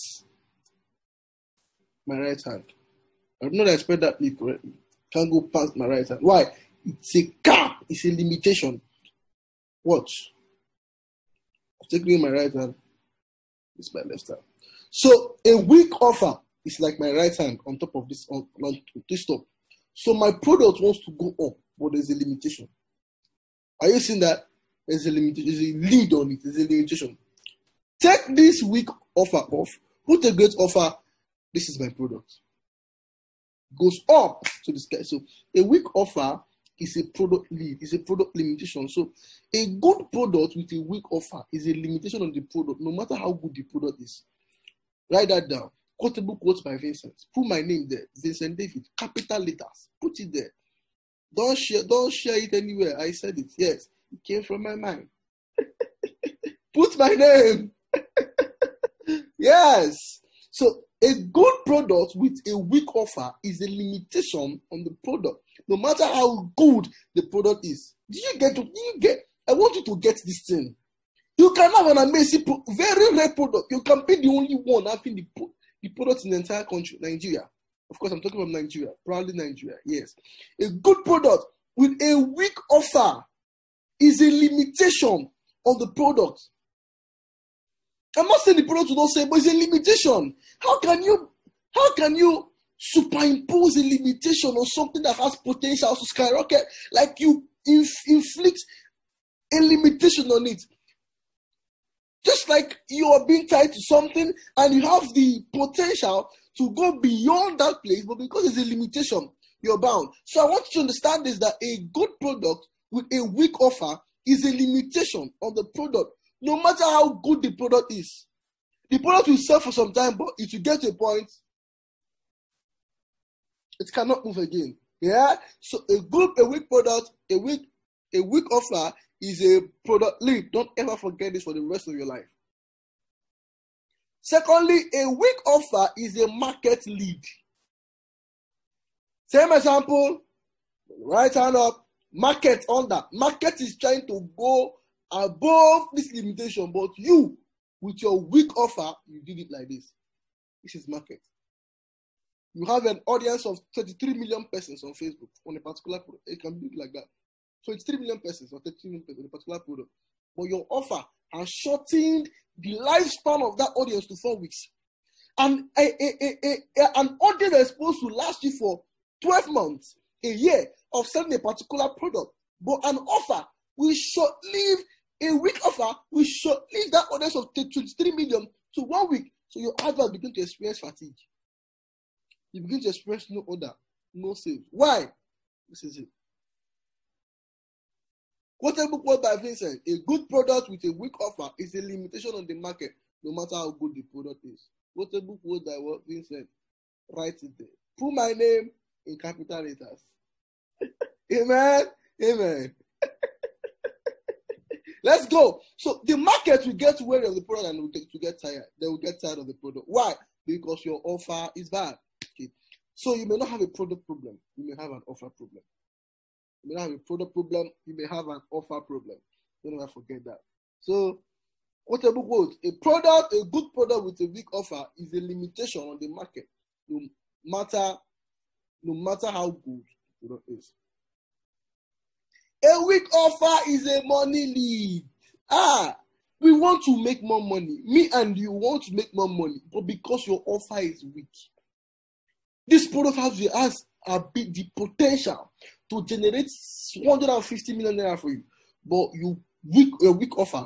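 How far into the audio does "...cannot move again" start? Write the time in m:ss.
2:03.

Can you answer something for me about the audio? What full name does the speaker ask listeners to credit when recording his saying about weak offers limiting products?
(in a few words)
Vincent David.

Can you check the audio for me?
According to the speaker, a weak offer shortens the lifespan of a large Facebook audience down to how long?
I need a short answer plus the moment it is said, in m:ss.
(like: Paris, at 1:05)
4 weeks, at 2:44.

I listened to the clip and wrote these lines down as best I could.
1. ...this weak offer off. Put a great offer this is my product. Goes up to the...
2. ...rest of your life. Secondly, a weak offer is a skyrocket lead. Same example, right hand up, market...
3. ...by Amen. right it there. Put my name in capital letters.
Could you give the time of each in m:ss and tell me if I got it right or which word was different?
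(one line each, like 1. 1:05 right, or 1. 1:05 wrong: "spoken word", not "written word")
1. 0:28 right
2. 2:11 wrong: "market", not "skyrocket"
3. 3:15 wrong: "Vincent", not "Amen".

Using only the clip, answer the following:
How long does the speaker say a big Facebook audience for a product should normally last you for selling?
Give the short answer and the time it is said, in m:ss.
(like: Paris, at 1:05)
12 months, at 2:49.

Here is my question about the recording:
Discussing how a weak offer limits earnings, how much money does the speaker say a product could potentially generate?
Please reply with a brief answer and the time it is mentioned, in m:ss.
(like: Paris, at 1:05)
150 million naira, at 4:06.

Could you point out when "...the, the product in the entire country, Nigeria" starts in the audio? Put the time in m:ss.
1:15.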